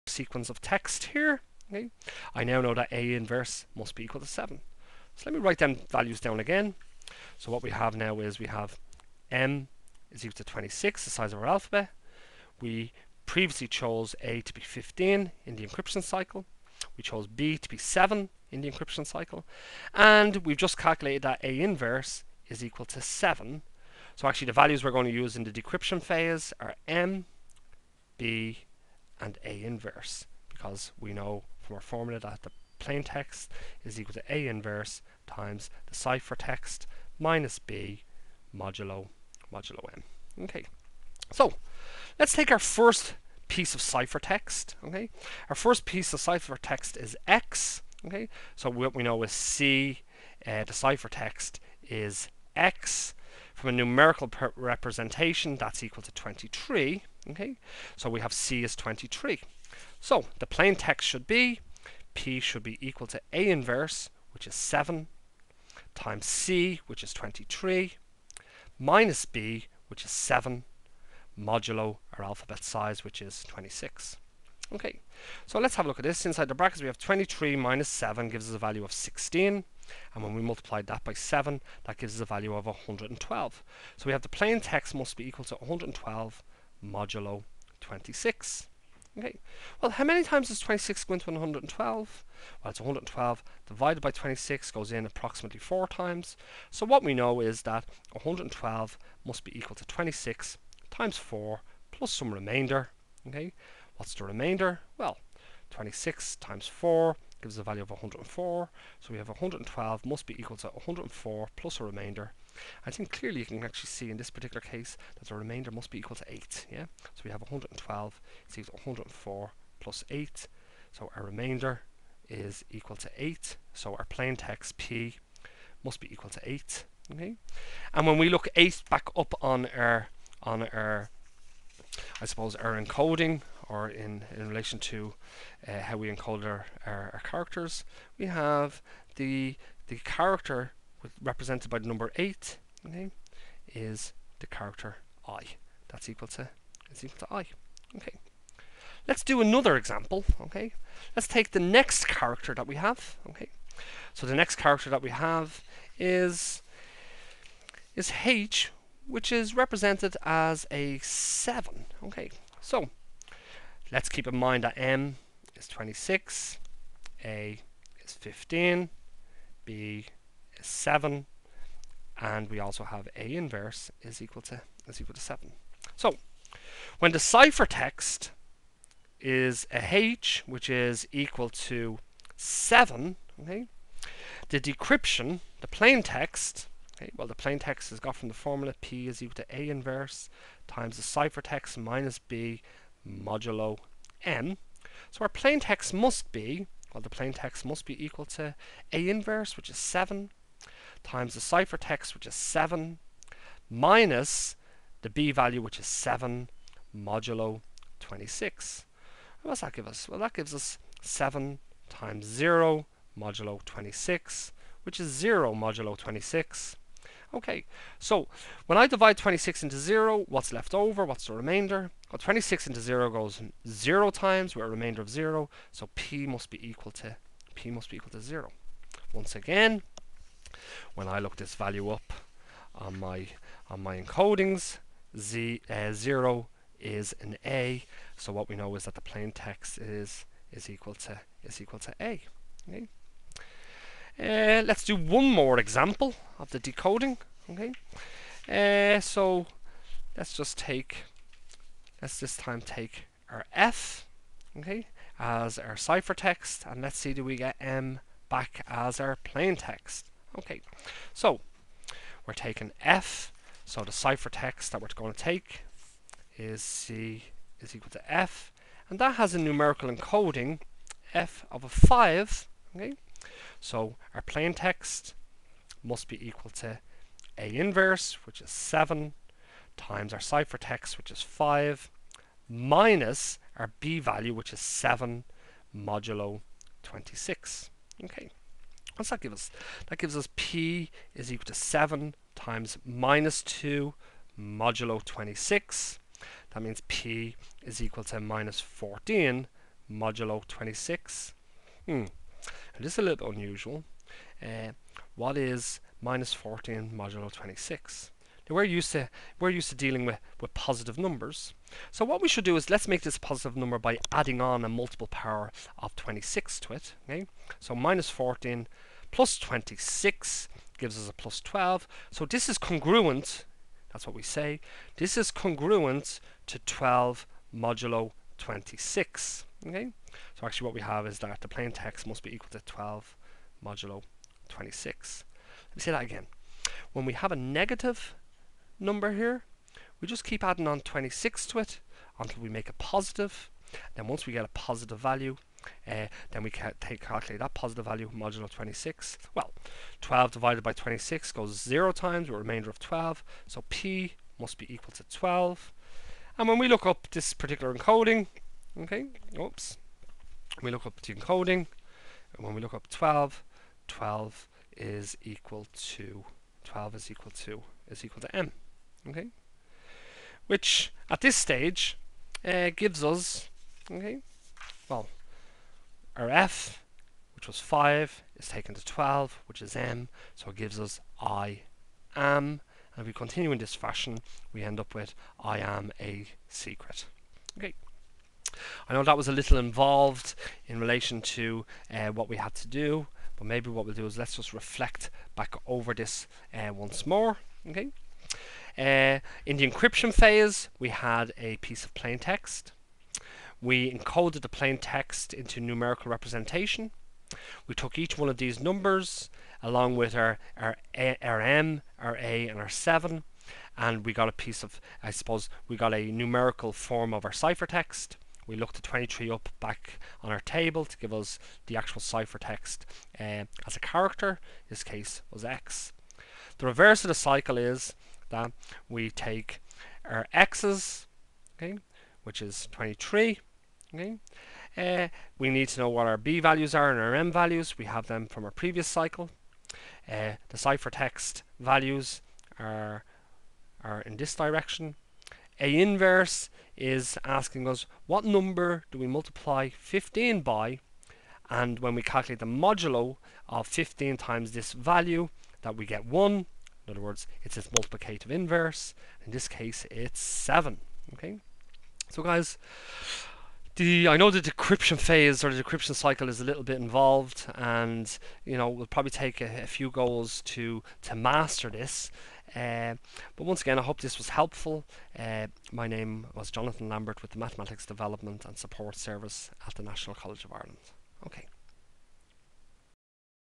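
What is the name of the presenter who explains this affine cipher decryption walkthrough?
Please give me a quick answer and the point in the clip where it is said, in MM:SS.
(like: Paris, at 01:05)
Jonathan Lambert, at 07:56.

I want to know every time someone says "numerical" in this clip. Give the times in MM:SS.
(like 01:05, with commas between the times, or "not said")
00:53, 04:29, 06:45, 06:56.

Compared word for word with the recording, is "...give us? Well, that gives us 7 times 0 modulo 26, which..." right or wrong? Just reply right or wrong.
right.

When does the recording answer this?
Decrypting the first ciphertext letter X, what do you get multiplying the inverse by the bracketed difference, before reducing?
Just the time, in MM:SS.
01:21.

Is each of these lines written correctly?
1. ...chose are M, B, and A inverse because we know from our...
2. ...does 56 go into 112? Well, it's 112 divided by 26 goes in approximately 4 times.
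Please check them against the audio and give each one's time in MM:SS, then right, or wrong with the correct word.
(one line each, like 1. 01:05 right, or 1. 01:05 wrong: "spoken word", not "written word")
1. 00:26 wrong: "phase", not "chose"
2. 01:30 wrong: "26", not "56".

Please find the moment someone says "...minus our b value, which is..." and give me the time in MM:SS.
04:42.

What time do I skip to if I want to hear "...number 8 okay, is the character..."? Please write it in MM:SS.
02:21.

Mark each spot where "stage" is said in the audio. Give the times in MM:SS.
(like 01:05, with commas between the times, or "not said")
06:11.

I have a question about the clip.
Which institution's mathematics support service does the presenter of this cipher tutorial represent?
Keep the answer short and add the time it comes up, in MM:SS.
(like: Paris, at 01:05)
National College of Ireland, at 07:59.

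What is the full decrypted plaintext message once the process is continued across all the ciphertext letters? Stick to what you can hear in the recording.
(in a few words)
I am a secret.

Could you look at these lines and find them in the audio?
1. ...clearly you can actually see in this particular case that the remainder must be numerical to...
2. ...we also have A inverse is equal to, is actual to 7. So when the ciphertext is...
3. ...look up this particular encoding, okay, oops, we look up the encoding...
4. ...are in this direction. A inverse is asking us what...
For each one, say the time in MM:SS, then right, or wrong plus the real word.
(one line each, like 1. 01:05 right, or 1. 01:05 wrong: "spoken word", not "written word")
1. 01:53 wrong: "equal", not "numerical"
2. 02:52 wrong: "equal", not "actual"
3. 05:56 right
4. 07:23 right.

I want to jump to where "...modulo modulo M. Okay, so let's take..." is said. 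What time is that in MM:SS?
00:38.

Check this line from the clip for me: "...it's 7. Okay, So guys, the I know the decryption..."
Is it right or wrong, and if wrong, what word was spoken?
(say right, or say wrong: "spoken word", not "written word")
right.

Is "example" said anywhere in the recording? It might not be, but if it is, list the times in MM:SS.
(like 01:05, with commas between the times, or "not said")
02:29, 04:05.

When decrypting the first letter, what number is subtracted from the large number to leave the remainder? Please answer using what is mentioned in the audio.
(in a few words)
104.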